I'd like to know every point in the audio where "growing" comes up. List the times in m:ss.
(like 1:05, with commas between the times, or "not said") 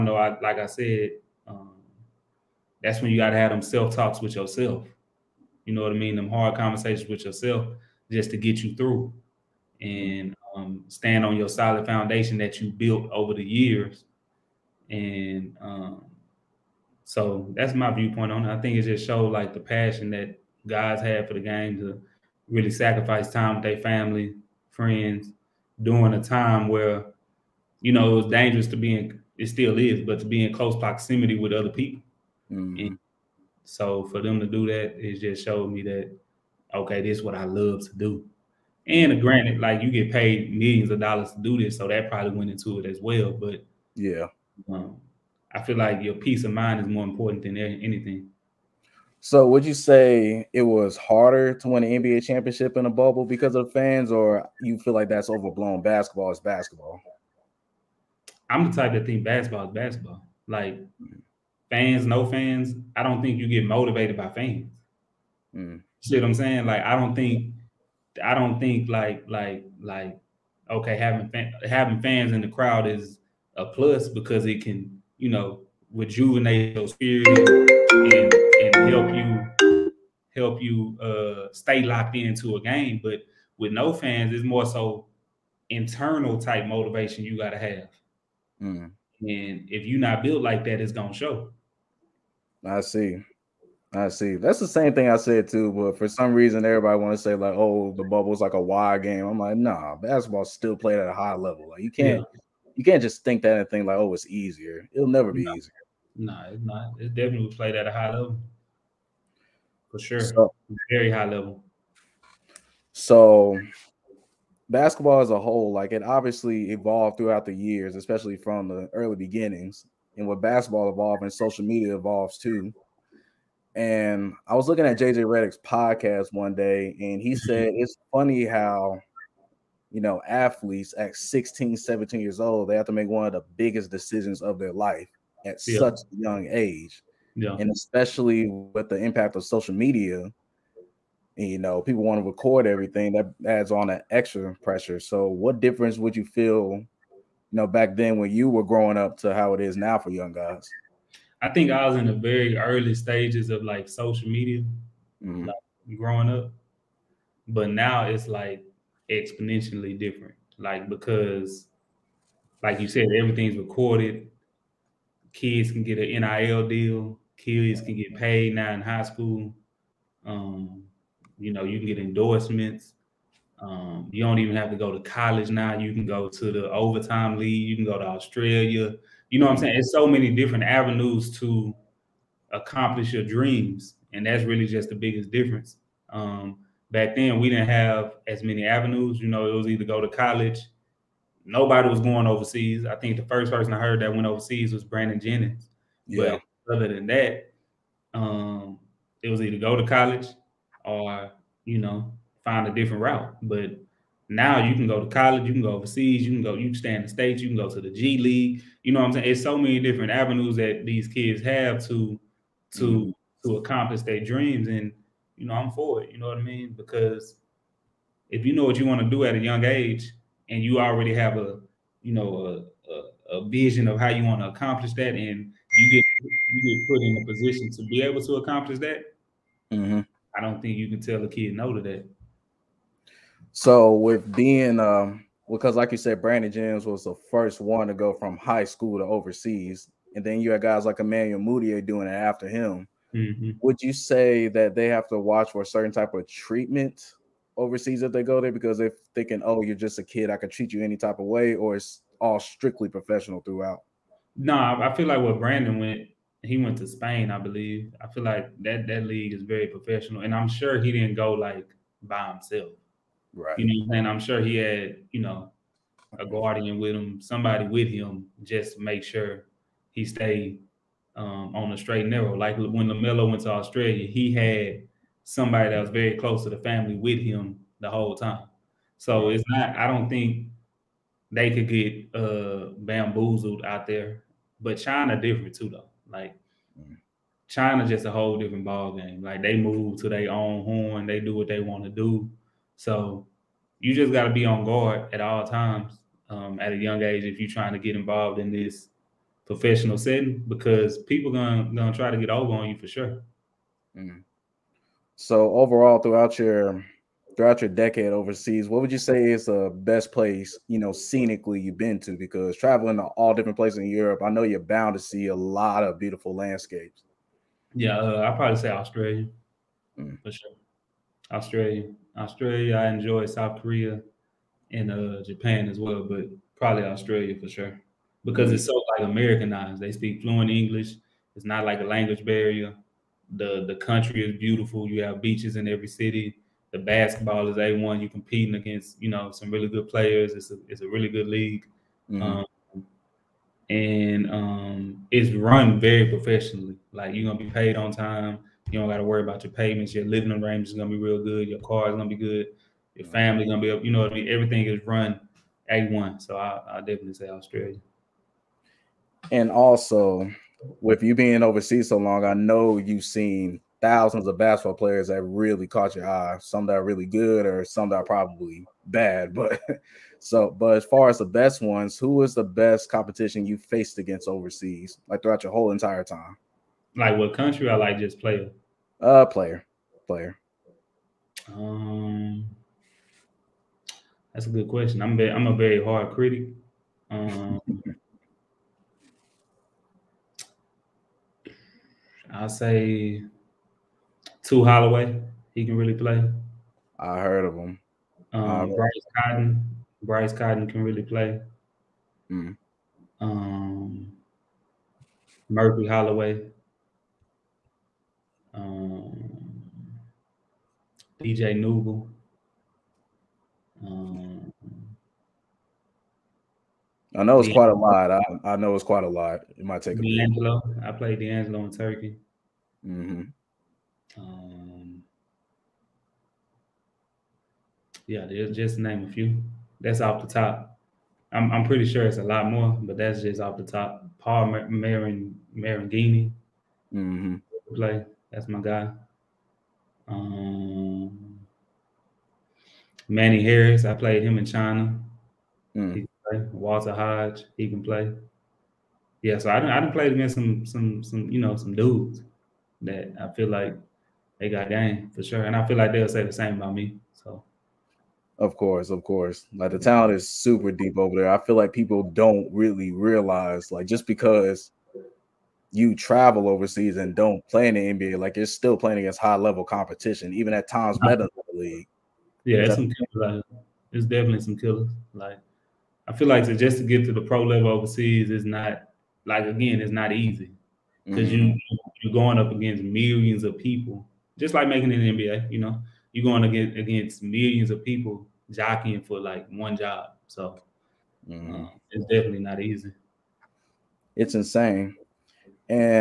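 2:28, 2:35.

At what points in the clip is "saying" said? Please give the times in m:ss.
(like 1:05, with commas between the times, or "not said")
1:06, 2:59, 3:29, 4:23.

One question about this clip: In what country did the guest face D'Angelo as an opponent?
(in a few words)
Turkey.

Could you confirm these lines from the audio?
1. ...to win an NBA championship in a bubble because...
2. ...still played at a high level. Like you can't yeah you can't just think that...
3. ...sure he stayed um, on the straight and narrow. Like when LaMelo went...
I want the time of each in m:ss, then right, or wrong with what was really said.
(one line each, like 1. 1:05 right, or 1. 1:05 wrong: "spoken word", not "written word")
1. 0:51 right
2. 1:40 right
3. 4:29 right.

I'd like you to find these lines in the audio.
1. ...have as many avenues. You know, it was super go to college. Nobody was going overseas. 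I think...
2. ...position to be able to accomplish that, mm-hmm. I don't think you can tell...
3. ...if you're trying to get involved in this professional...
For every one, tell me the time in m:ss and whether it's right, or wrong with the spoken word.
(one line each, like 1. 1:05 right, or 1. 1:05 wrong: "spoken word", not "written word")
1. 3:07 wrong: "either", not "super"
2. 3:47 right
3. 4:57 right.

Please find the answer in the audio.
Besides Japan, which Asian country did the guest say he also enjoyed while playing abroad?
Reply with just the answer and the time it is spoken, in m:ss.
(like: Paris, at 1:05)
South Korea, at 5:23.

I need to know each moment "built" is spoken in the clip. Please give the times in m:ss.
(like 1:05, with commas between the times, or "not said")
0:12, 1:30.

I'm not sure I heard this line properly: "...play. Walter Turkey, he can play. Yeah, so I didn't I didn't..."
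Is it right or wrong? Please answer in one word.
wrong.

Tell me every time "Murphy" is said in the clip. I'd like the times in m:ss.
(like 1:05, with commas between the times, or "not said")
6:45.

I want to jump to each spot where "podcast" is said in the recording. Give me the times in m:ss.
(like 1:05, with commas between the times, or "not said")
2:05.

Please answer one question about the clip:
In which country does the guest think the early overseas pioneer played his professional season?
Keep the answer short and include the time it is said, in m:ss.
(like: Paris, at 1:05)
Spain, at 4:16.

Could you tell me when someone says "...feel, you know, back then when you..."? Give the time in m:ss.
2:26.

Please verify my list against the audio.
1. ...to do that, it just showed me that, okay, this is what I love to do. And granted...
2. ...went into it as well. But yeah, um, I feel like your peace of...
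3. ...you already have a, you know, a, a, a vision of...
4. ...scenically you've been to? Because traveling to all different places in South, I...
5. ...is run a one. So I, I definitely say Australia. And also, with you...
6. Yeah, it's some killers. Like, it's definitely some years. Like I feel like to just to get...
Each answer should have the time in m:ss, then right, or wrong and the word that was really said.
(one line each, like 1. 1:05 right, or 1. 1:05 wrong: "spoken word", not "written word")
1. 0:34 right
2. 0:42 right
3. 3:40 right
4. 5:10 wrong: "Europe", not "South"
5. 5:54 right
6. 7:52 wrong: "killers", not "years".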